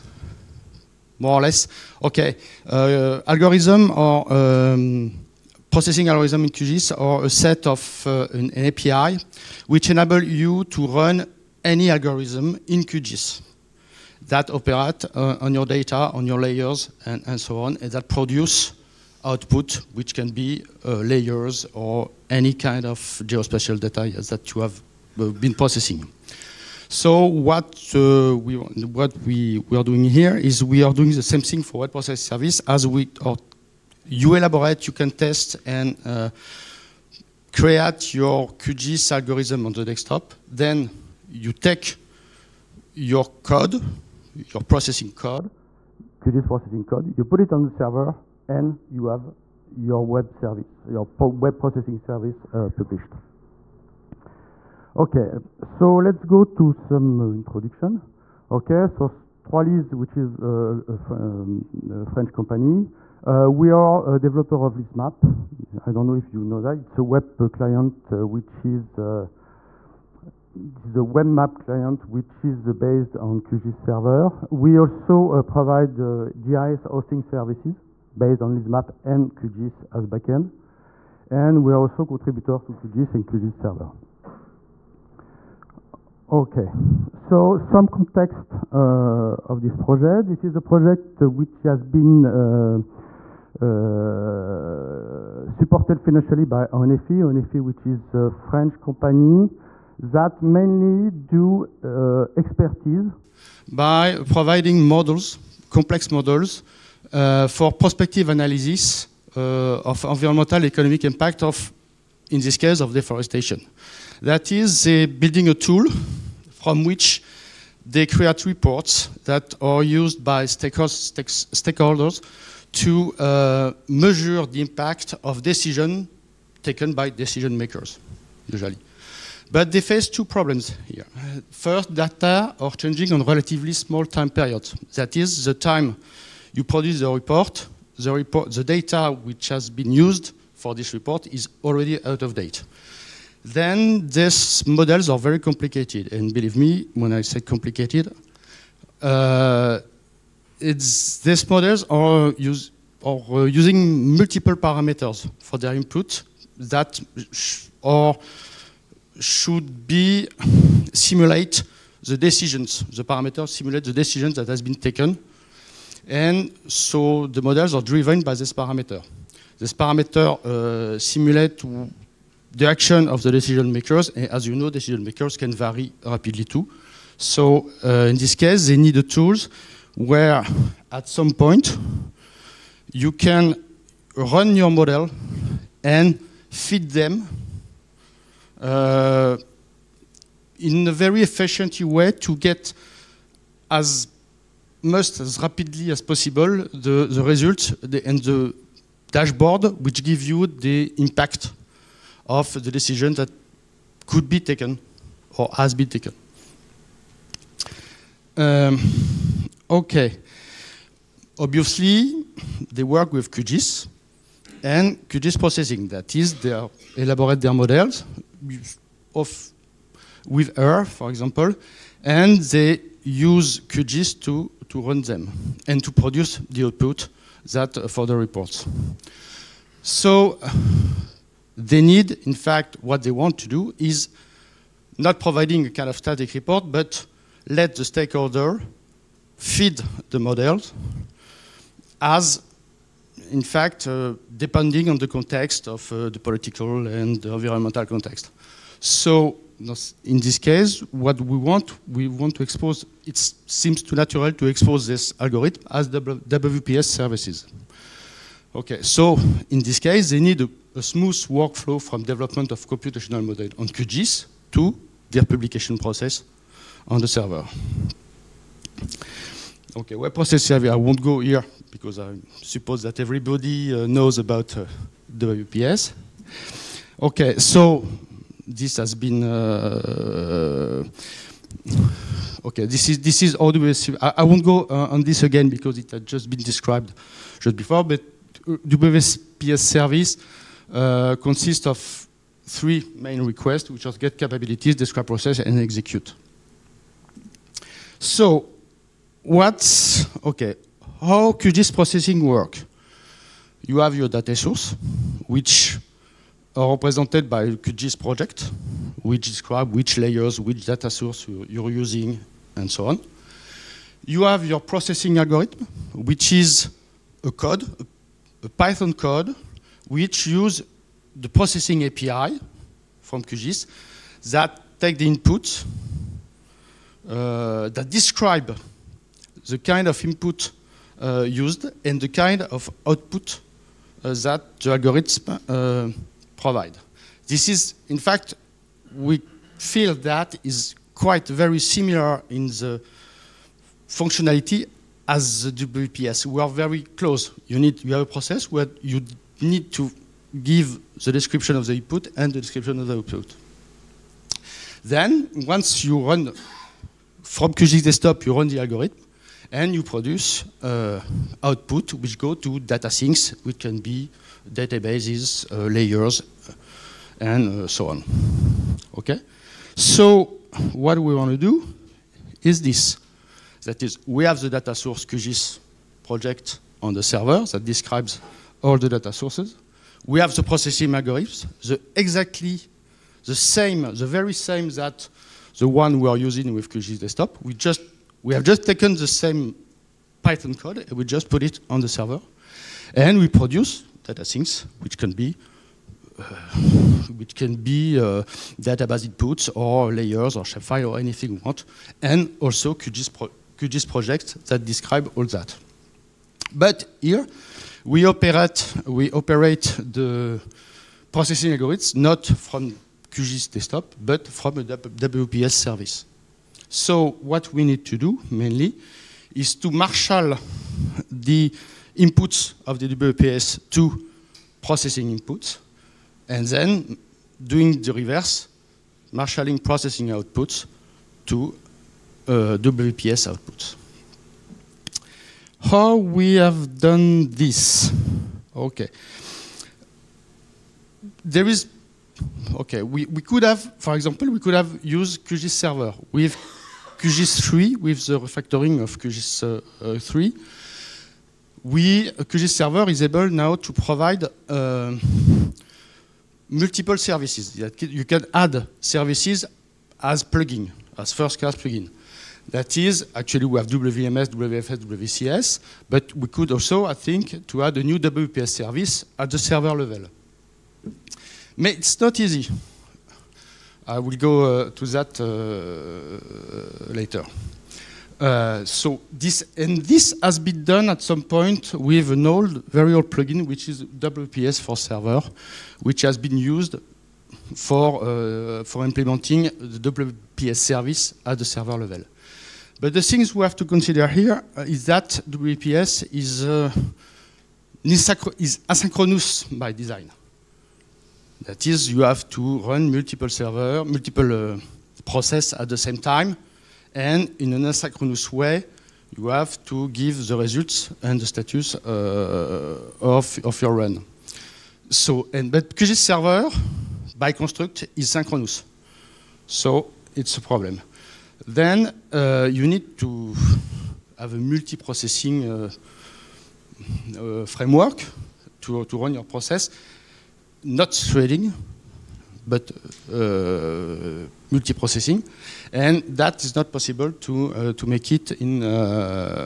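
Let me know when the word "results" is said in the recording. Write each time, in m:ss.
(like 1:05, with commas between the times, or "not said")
3:17, 8:30.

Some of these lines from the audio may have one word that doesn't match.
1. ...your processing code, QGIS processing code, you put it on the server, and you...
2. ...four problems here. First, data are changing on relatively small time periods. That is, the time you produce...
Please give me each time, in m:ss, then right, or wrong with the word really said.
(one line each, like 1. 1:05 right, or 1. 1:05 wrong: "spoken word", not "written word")
1. 0:44 right
2. 2:10 wrong: "two", not "four".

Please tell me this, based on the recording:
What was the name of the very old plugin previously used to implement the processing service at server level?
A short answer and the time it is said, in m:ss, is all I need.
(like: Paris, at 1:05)
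WPS for server, at 8:03.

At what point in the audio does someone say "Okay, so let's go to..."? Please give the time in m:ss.
0:54.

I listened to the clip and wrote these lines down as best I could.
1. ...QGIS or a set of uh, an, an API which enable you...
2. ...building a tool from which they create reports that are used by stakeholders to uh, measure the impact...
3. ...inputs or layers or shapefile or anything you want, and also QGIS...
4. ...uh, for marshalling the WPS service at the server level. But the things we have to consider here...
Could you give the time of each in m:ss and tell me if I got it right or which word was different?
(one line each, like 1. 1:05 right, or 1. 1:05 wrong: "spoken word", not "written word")
1. 0:06 right
2. 1:55 right
3. 6:39 right
4. 8:08 wrong: "implementing", not "marshalling".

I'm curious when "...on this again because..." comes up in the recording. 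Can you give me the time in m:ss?
4:44.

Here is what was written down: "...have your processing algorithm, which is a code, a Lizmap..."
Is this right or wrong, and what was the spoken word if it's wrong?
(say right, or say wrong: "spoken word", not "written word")
wrong: "Python", not "Lizmap".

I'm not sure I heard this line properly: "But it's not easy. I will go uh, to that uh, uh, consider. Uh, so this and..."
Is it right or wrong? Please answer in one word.
wrong.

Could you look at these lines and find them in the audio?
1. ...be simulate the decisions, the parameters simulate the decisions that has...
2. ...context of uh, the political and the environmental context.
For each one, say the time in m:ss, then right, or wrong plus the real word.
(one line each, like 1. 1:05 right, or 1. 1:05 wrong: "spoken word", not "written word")
1. 2:39 right
2. 4:05 right.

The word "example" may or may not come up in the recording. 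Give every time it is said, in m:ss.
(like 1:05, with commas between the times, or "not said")
3:41, 7:23.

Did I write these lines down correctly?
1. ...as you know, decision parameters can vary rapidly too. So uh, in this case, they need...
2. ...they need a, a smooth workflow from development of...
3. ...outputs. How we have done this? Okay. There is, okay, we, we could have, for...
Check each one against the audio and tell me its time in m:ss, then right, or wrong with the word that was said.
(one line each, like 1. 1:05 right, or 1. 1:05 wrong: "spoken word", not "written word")
1. 2:54 wrong: "makers", not "parameters"
2. 4:20 right
3. 7:13 right.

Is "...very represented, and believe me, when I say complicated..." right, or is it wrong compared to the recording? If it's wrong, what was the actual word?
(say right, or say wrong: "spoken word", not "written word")
wrong: "complicated", not "represented".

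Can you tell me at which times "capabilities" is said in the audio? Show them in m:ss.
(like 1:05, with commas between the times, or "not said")
4:54.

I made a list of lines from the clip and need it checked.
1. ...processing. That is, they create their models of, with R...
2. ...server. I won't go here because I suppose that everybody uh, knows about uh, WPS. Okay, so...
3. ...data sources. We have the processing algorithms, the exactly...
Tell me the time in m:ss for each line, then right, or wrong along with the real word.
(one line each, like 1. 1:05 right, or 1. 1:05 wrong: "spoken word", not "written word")
1. 3:35 wrong: "elaborate", not "create"
2. 4:30 right
3. 6:18 right.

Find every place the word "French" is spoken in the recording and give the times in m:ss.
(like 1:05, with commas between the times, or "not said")
1:02, 1:38.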